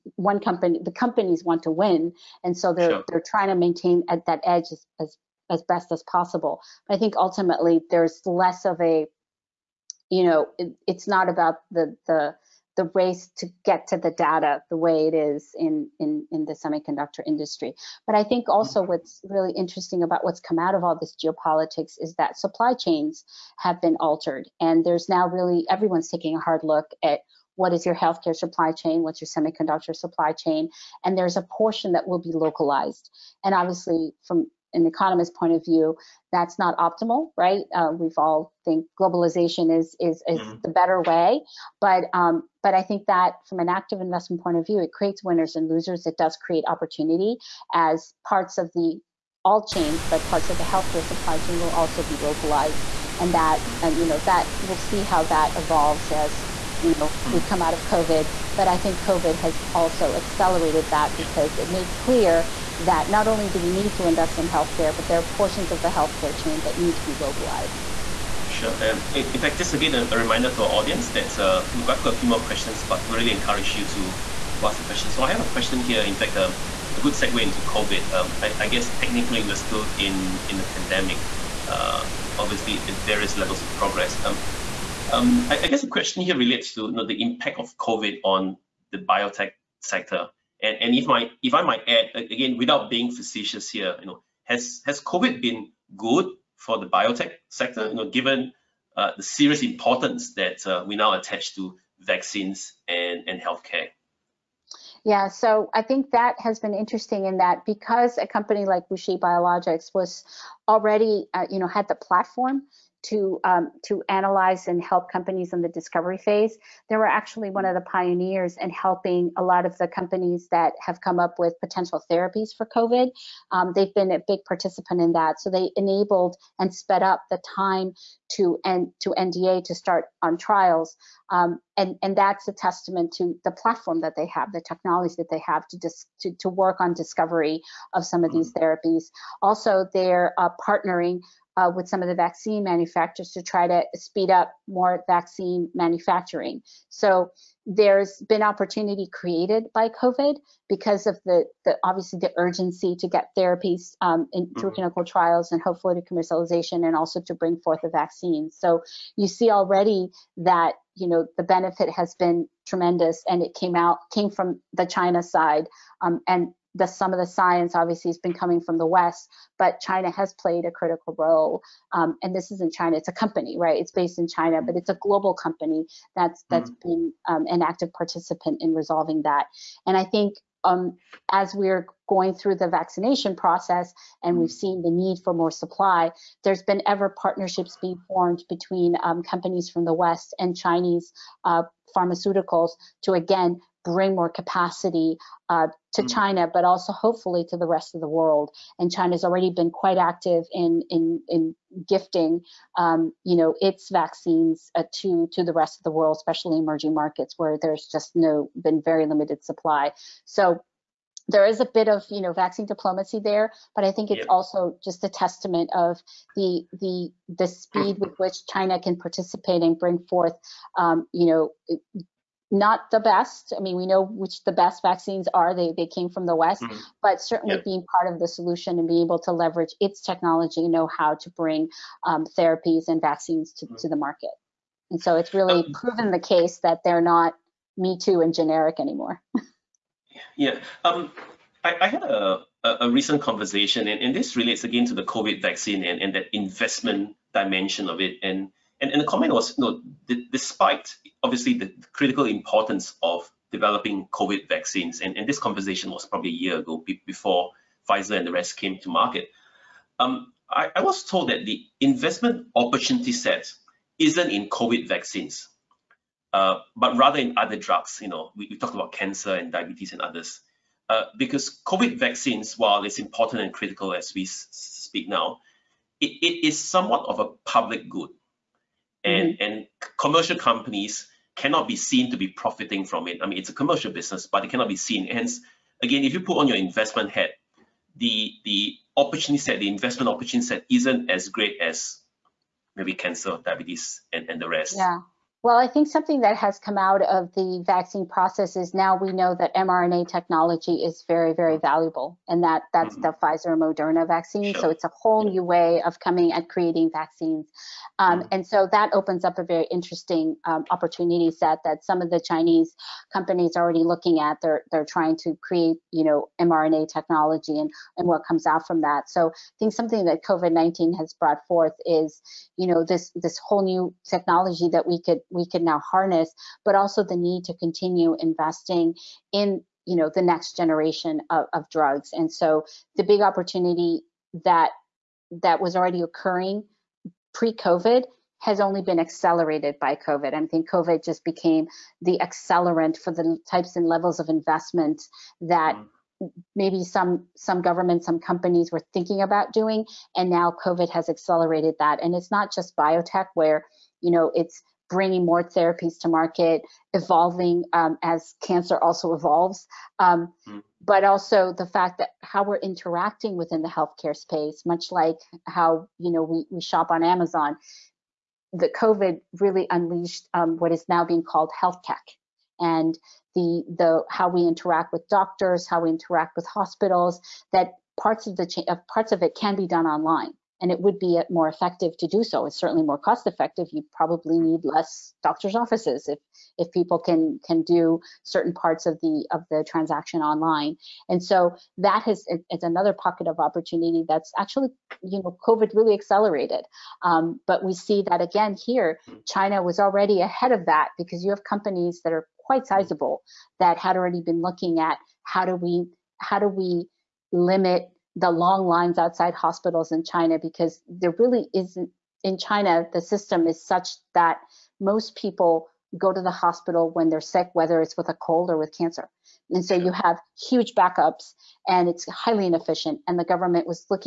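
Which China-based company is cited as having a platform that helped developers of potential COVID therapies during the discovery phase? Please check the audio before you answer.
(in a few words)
WuXi Biologics.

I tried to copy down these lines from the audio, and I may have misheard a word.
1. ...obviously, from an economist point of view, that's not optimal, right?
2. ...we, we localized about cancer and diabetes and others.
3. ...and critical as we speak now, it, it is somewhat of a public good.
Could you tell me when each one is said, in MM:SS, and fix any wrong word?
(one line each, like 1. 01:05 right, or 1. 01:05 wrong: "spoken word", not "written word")
1. 00:33 right
2. 04:28 wrong: "talked", not "localized"
3. 04:33 right.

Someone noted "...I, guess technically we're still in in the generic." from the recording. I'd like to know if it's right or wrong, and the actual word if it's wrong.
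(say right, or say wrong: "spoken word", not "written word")
wrong: "pandemic", not "generic".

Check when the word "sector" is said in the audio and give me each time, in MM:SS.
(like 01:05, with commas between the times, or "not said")
01:29, 01:37.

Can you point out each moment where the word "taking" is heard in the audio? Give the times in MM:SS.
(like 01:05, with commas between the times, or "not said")
00:26.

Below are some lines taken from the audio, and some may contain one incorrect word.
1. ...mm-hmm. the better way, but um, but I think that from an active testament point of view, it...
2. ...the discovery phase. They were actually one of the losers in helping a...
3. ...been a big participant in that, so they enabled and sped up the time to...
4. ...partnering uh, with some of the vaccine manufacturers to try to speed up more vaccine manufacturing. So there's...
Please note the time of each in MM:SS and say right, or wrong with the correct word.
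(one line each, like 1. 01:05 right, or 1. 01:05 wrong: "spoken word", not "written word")
1. 00:40 wrong: "investment", not "testament"
2. 01:55 wrong: "pioneers", not "losers"
3. 02:03 right
4. 02:20 right.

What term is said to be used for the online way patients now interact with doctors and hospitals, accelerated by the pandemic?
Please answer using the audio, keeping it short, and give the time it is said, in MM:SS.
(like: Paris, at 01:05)
health tech, at 06:11.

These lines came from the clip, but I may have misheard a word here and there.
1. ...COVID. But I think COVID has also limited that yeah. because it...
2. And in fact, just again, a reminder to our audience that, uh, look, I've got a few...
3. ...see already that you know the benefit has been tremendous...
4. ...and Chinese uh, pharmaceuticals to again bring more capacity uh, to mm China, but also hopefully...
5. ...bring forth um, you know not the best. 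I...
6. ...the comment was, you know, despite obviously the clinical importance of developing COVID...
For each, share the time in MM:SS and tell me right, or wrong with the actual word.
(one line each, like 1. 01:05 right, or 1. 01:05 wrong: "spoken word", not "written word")
1. 00:57 wrong: "accelerated", not "limited"
2. 01:08 right
3. 02:39 right
4. 03:10 right
5. 03:39 right
6. 04:09 wrong: "critical", not "clinical".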